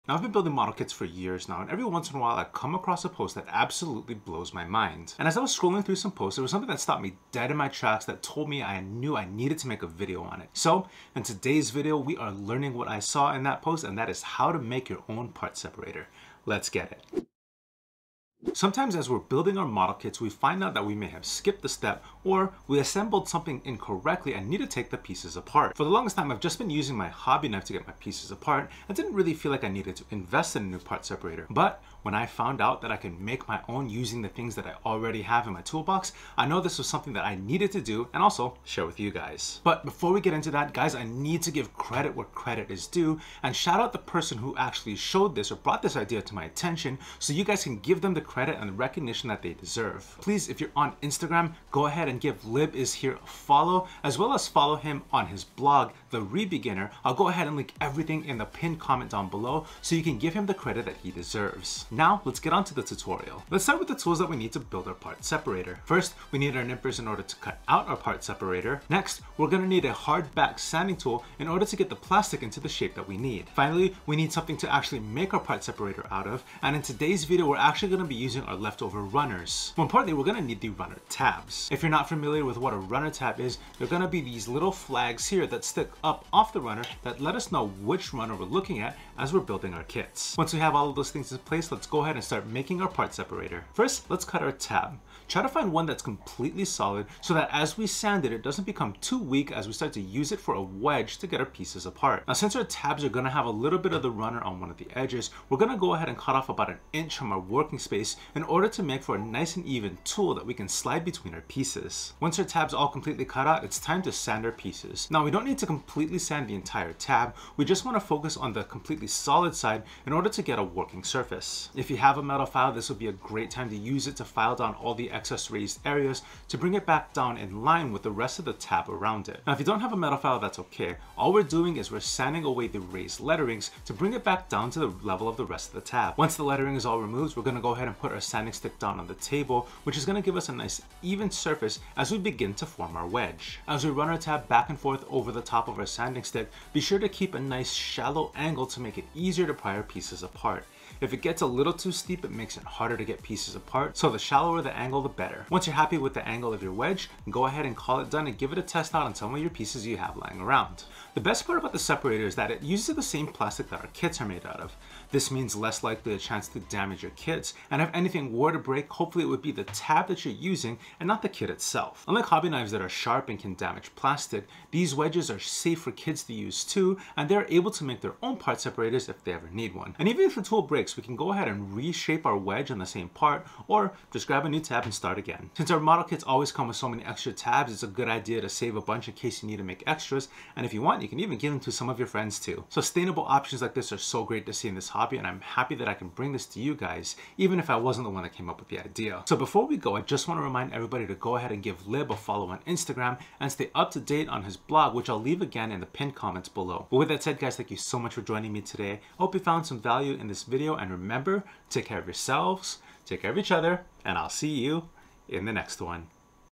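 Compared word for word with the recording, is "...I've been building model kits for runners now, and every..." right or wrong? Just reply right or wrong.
wrong.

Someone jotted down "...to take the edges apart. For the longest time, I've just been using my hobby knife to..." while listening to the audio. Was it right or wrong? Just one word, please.
wrong.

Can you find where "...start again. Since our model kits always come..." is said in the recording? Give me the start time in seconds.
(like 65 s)
184 s.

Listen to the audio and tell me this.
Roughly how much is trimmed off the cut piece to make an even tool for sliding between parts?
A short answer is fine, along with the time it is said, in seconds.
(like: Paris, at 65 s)
About an inch, at 106 s.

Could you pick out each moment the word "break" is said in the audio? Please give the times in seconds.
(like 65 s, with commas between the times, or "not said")
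168 s, 180 s.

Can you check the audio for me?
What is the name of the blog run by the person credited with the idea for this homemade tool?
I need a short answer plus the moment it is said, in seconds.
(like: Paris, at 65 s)
The Rebeginner, at 56 s.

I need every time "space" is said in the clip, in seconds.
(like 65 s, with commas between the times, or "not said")
107 s.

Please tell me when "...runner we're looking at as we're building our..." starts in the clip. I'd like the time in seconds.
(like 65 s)
88 s.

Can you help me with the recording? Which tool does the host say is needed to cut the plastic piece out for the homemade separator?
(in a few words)
Nippers.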